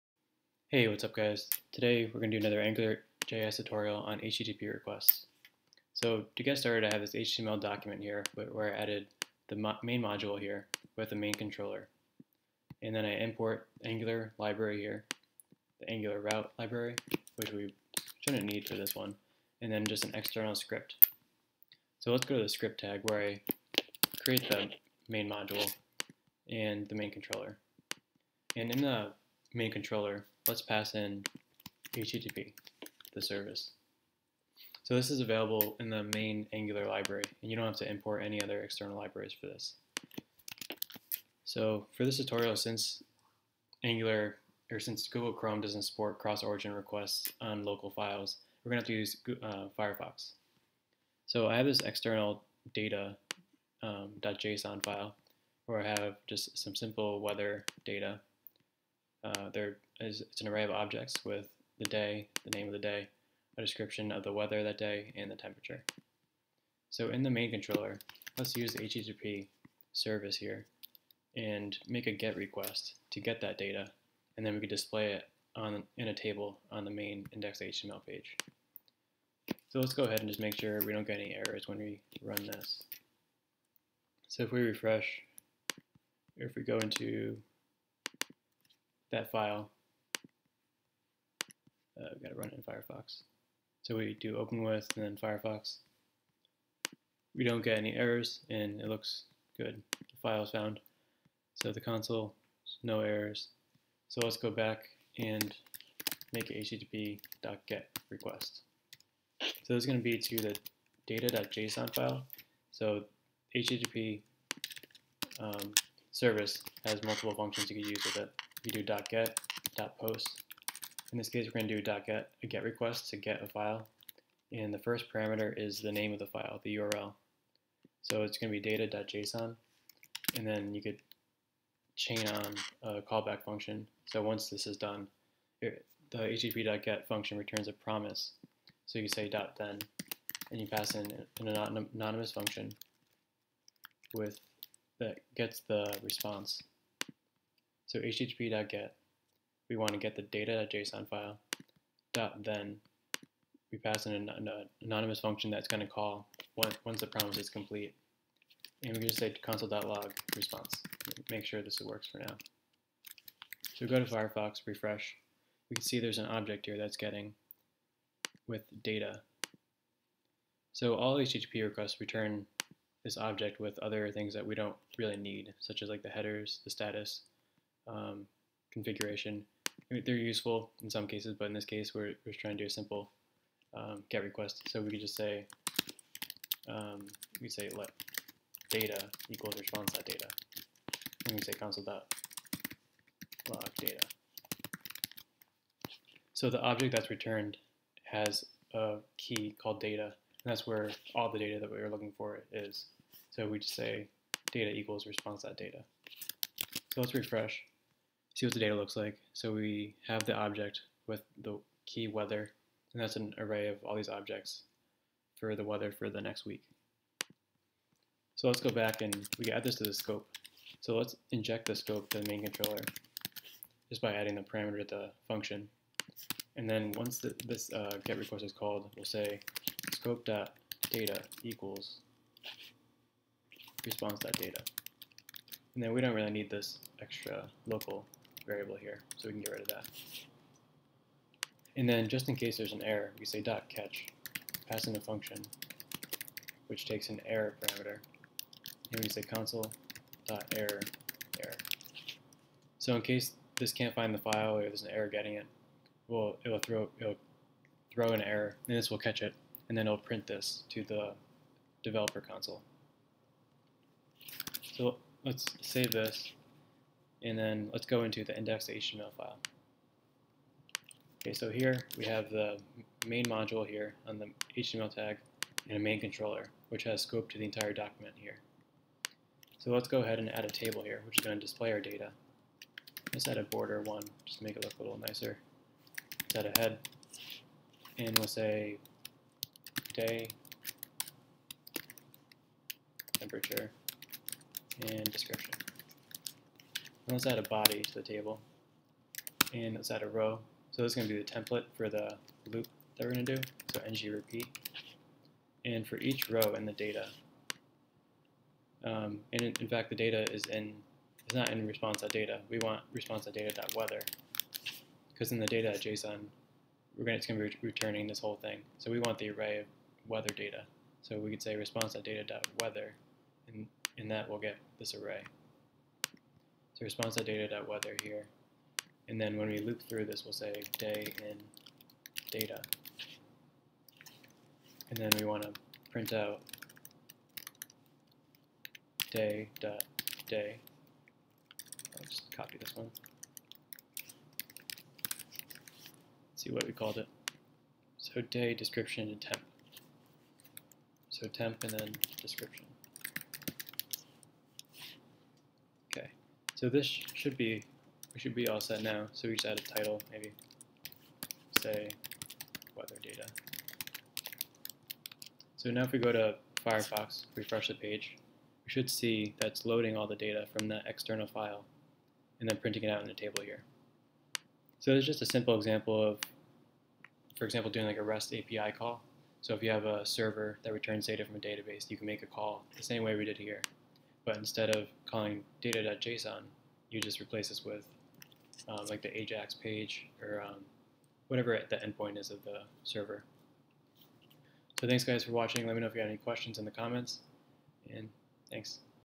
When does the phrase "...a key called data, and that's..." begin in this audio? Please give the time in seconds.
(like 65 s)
198 s.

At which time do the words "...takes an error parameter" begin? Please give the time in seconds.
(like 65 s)
246 s.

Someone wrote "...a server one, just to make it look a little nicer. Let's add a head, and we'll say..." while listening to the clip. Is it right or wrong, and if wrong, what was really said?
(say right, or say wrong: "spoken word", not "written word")
wrong: "border", not "server".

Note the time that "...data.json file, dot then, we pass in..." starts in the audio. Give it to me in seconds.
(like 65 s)
150 s.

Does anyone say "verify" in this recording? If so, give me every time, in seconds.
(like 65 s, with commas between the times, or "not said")
not said.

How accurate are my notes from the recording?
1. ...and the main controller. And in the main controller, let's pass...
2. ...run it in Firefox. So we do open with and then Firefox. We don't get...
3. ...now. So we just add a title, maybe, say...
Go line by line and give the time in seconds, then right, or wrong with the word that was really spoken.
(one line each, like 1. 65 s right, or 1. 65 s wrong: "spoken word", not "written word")
1. 26 s right
2. 92 s right
3. 358 s right.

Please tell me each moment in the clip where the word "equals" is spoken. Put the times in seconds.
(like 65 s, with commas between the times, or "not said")
189 s, 204 s, 231 s.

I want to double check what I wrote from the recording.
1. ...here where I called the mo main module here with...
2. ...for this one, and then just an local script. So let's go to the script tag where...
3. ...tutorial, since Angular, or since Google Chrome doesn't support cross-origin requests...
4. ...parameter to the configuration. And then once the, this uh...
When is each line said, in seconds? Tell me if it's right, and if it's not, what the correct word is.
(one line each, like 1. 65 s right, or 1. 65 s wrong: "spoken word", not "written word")
1. 7 s wrong: "added", not "called"
2. 18 s wrong: "external", not "local"
3. 42 s right
4. 224 s wrong: "function", not "configuration".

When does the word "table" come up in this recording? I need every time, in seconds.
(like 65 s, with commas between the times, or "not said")
76 s, 280 s, 298 s, 373 s.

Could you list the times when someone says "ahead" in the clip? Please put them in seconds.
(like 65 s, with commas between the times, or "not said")
80 s, 280 s.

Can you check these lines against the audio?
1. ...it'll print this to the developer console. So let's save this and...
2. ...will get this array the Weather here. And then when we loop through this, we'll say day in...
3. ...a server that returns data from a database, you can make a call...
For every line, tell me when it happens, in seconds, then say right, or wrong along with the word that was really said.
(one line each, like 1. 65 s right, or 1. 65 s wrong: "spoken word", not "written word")
1. 259 s right
2. 324 s right
3. 379 s right.